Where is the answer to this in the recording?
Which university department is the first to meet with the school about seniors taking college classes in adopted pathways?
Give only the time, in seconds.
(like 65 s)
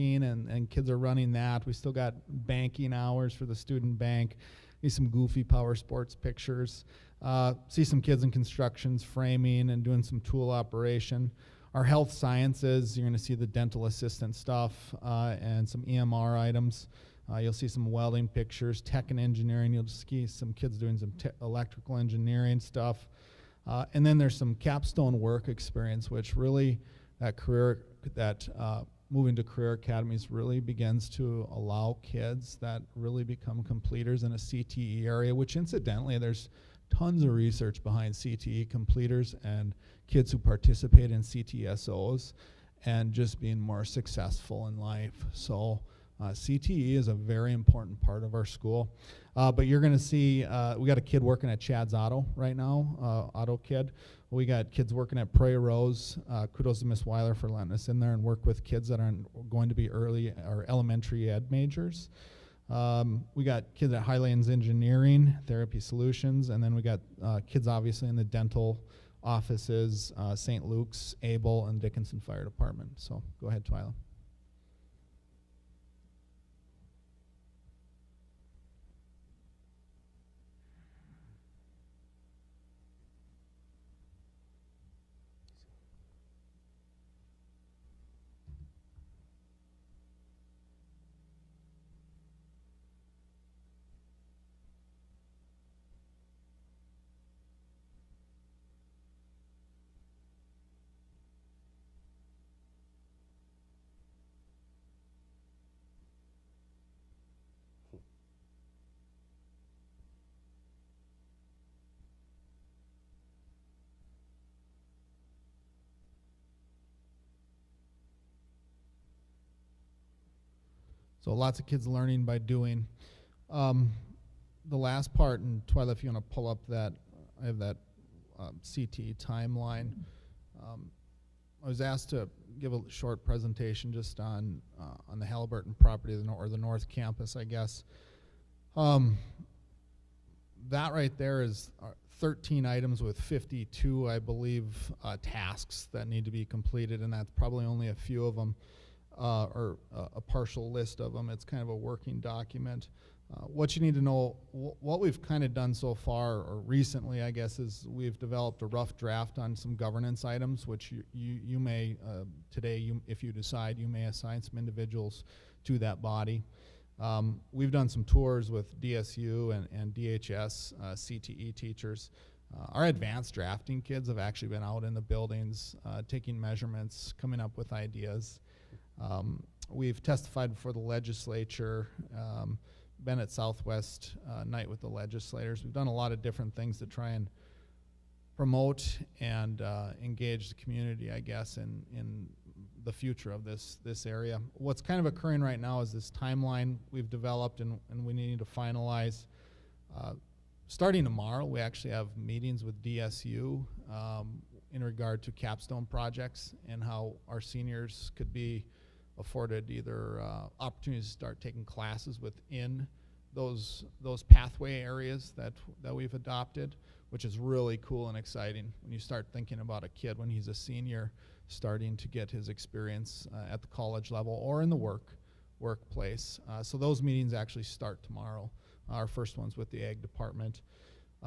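229 s.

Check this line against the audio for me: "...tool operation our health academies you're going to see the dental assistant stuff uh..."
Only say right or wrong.
wrong.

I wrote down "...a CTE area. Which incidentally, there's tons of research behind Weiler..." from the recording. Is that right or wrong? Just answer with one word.
wrong.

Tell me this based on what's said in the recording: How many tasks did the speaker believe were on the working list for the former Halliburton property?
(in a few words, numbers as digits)
52.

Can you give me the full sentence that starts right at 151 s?
It's kind of a working document.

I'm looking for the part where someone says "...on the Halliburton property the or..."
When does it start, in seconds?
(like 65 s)
135 s.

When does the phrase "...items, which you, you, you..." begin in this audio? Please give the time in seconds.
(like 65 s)
160 s.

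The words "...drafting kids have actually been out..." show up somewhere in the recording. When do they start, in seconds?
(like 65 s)
173 s.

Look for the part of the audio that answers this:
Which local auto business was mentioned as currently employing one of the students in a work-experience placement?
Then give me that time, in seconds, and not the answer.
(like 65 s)
51 s.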